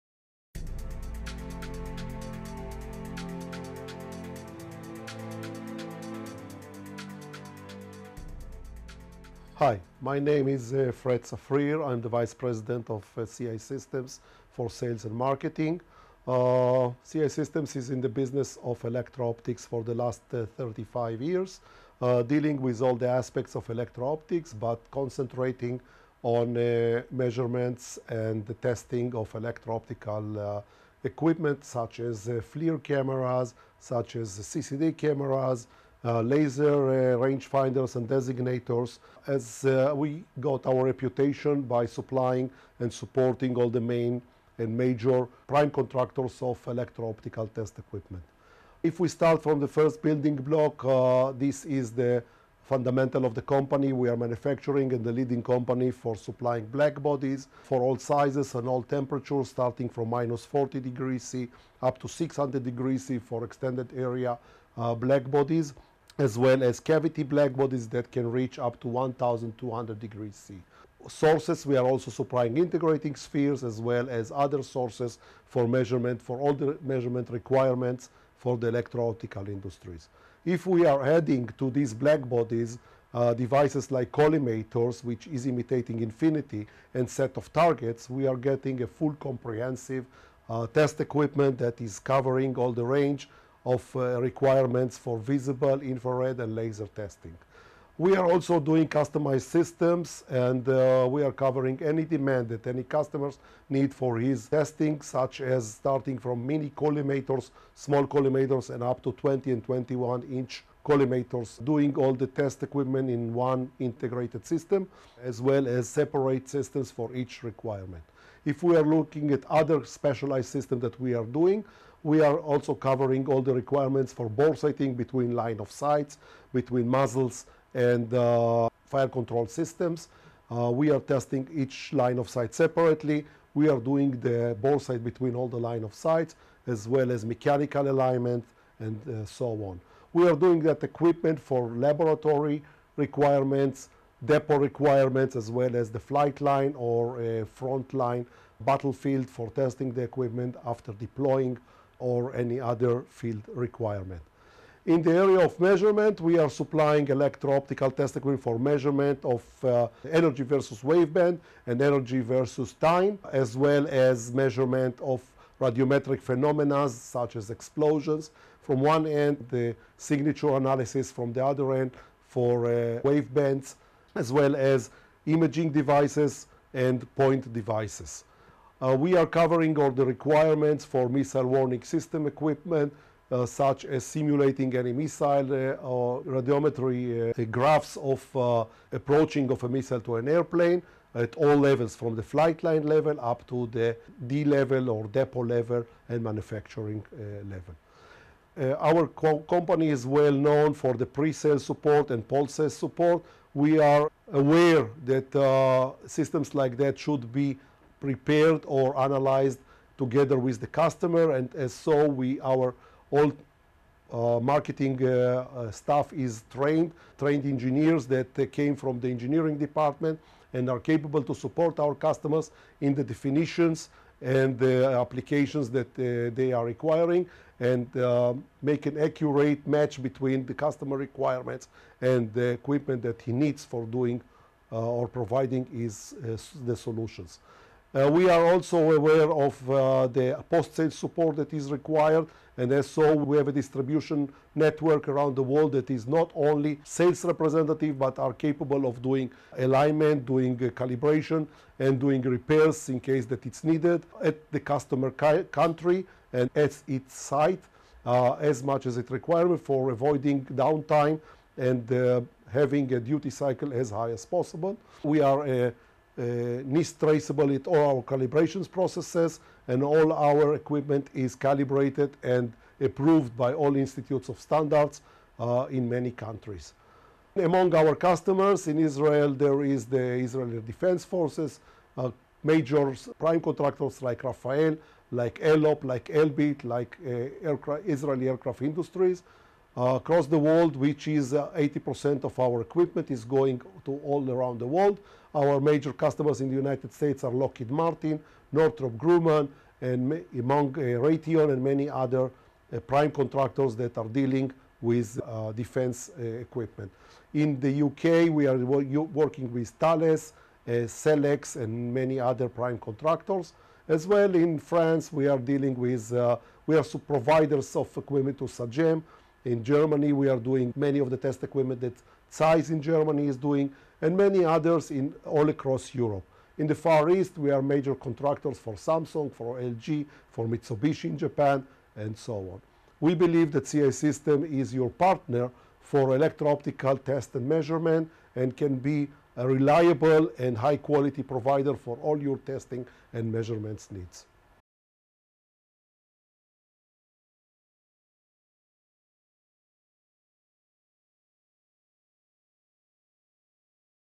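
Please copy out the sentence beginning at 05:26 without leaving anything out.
In the Far East, we are major contractors for Samsung, for LG, for Mitsubishi in Japan, and so on.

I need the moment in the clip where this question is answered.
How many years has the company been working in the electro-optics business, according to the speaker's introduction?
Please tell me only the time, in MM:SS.
00:20.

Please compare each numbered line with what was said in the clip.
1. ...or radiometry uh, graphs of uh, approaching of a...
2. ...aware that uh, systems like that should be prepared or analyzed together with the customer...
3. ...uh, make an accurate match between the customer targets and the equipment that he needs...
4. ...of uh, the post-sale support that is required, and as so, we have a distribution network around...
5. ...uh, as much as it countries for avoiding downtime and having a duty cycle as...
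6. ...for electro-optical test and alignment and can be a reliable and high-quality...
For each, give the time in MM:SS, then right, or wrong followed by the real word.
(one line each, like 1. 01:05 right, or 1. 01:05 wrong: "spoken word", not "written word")
1. 03:05 right
2. 03:24 right
3. 03:47 wrong: "requirements", not "targets"
4. 03:59 right
5. 04:18 wrong: "requires", not "countries"
6. 05:35 wrong: "measurement", not "alignment".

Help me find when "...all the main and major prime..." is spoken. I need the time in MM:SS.
00:43.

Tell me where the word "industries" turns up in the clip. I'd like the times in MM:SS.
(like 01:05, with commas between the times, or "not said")
01:19, 04:48.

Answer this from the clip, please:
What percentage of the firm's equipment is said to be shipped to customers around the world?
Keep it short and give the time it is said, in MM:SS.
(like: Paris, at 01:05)
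80%, at 04:51.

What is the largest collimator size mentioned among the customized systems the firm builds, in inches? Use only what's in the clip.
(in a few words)
21 inch.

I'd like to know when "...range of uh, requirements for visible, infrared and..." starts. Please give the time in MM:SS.
01:32.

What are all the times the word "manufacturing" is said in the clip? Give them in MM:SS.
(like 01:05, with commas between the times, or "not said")
00:54, 03:16.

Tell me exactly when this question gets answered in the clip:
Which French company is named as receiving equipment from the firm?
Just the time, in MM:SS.
05:18.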